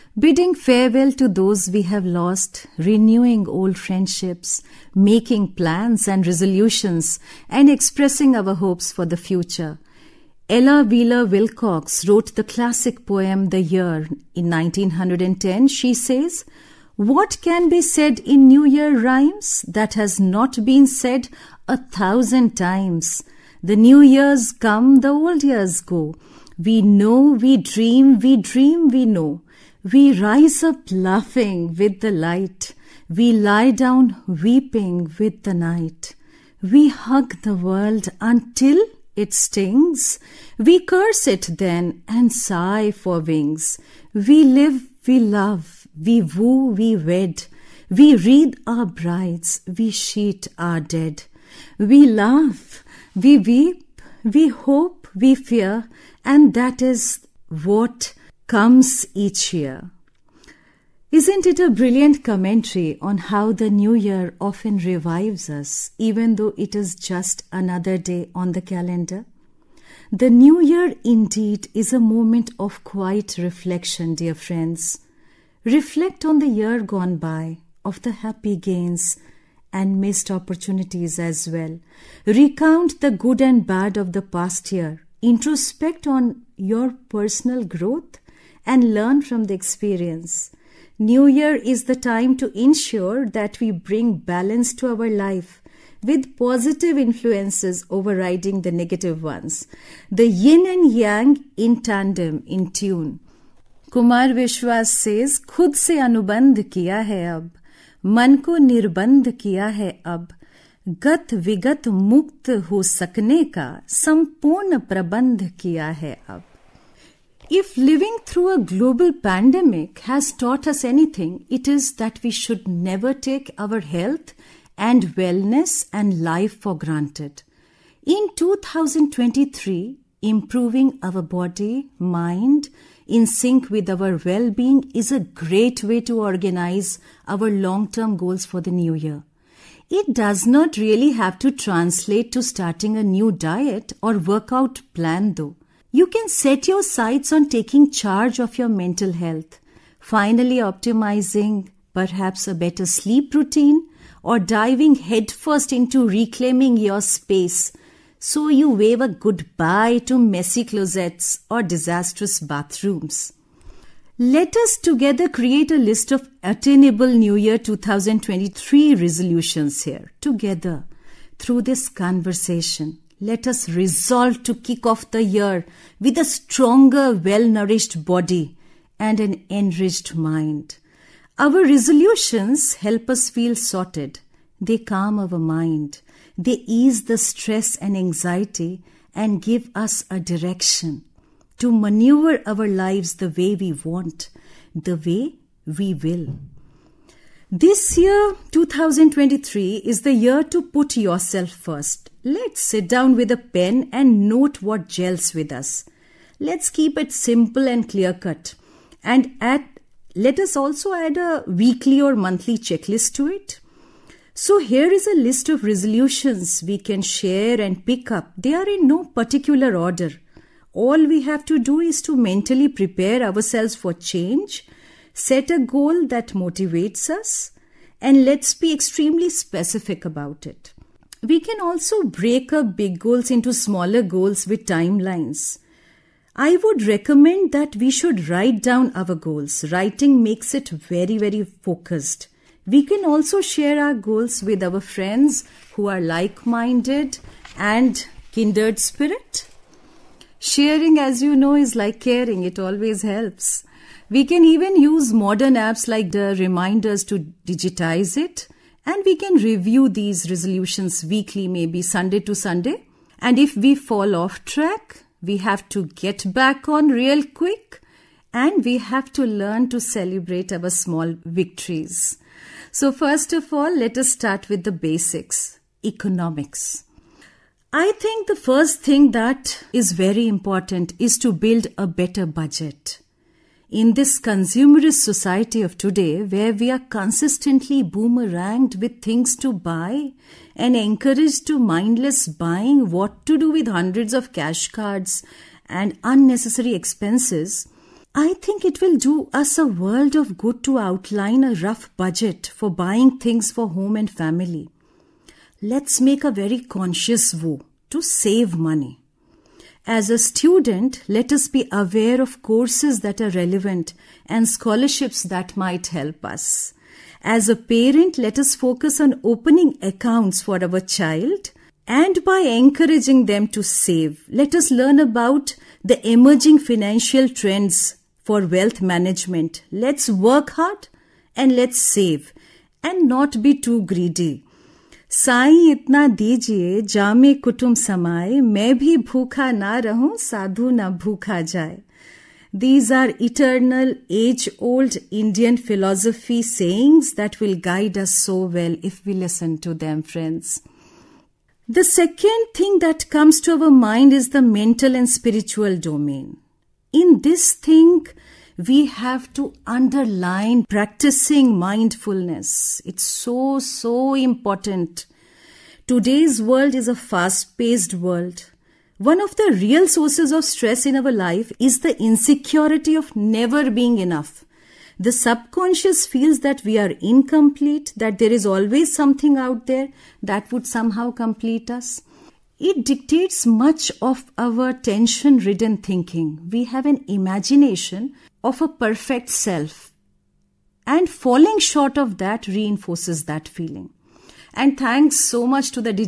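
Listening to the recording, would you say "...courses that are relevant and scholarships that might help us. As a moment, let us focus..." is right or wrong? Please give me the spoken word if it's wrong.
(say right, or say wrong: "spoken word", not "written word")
wrong: "parent", not "moment".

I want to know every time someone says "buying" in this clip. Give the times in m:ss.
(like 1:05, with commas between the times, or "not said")
4:52, 5:02.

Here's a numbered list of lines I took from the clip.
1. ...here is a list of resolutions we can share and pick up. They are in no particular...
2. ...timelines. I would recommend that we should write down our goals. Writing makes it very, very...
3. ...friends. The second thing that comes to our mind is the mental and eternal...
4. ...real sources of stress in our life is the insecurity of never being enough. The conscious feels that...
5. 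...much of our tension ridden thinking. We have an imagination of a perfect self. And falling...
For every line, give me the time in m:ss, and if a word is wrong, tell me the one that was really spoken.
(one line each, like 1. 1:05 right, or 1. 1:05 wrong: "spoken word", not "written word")
1. 3:34 right
2. 3:54 right
3. 5:50 wrong: "spiritual", not "eternal"
4. 6:09 wrong: "subconscious", not "conscious"
5. 6:23 right.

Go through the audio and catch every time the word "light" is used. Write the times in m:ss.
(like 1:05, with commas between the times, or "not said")
0:32.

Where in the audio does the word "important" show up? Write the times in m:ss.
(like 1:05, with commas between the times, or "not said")
4:40, 6:04.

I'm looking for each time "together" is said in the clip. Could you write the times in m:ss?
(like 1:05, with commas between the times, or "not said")
2:44, 2:50.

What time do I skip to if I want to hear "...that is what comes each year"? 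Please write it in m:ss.
0:56.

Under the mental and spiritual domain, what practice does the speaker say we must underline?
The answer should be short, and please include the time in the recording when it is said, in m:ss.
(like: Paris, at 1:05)
Mindfulness, at 6:01.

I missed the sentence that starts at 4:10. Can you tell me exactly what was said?
Sharing, as you know, is like caring, it always helps.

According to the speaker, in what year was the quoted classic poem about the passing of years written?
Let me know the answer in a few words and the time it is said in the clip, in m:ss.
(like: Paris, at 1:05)
1910, at 0:14.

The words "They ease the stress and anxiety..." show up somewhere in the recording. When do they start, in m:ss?
3:06.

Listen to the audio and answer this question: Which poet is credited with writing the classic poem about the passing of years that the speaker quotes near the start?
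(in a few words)
Ella Wheeler Wilcox.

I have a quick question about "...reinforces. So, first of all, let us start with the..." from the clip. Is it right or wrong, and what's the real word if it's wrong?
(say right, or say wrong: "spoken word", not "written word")
wrong: "victories", not "reinforces".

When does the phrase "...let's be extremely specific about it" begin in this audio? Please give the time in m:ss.
3:48.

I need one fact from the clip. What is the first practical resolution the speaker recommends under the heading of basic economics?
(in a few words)
Build a better budget.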